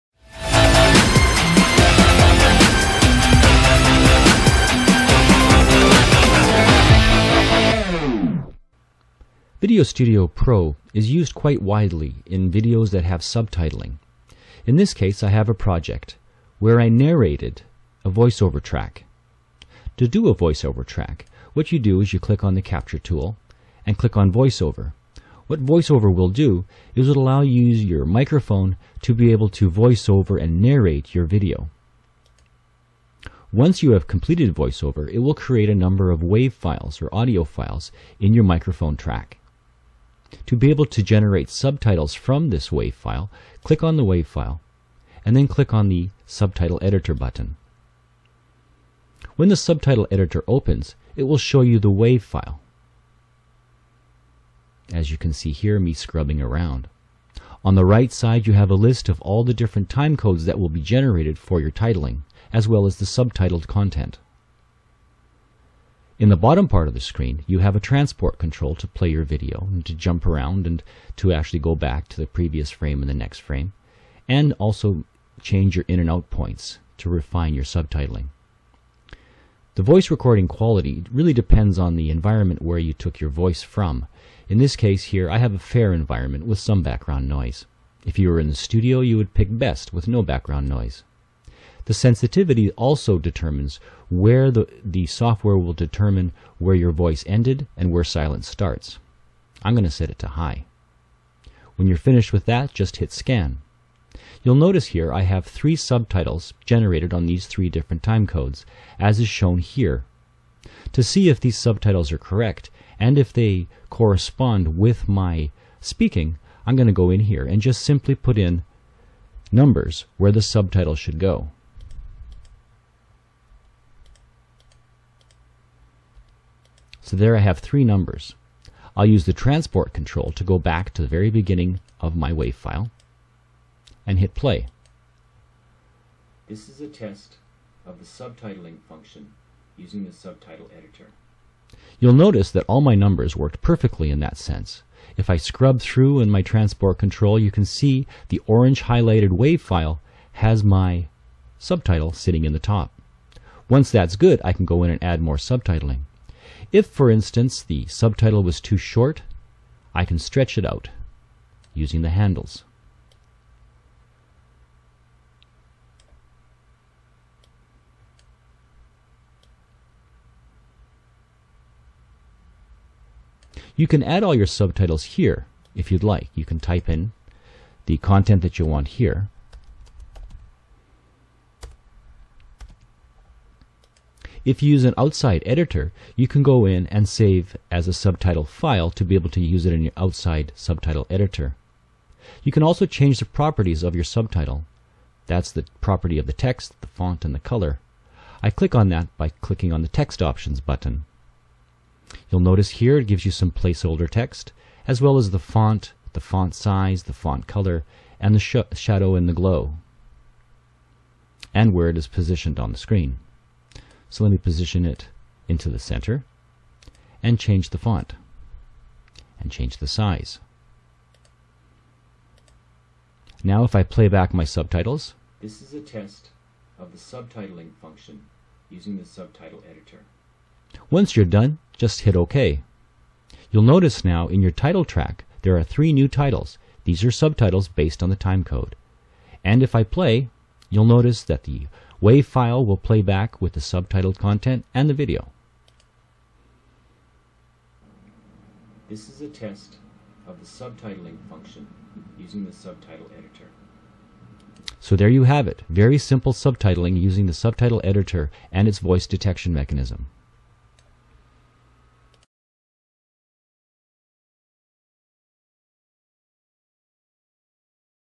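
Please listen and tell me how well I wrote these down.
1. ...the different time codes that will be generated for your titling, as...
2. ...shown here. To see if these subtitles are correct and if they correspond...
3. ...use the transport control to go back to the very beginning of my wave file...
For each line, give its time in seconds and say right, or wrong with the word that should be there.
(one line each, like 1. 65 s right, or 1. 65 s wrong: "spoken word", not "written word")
1. 59 s right
2. 109 s right
3. 129 s right.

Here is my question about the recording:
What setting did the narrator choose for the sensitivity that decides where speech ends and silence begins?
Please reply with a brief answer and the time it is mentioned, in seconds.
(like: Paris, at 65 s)
High, at 100 s.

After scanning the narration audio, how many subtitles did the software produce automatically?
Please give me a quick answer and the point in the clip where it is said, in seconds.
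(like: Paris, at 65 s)
3, at 105 s.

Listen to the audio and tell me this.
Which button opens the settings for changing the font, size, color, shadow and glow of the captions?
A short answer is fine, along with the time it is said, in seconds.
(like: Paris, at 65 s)
Text Options, at 199 s.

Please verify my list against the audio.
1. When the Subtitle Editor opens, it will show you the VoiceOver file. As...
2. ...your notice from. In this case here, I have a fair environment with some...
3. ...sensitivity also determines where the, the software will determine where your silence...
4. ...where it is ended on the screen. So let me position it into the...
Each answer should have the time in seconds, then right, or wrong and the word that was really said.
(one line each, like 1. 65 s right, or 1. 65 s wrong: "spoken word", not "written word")
1. 49 s wrong: "WAV", not "VoiceOver"
2. 83 s wrong: "voice", not "notice"
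3. 91 s wrong: "voice", not "silence"
4. 211 s wrong: "positioned", not "ended".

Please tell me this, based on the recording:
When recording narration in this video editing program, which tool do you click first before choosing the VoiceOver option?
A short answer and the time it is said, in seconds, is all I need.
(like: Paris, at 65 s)
Capture, at 22 s.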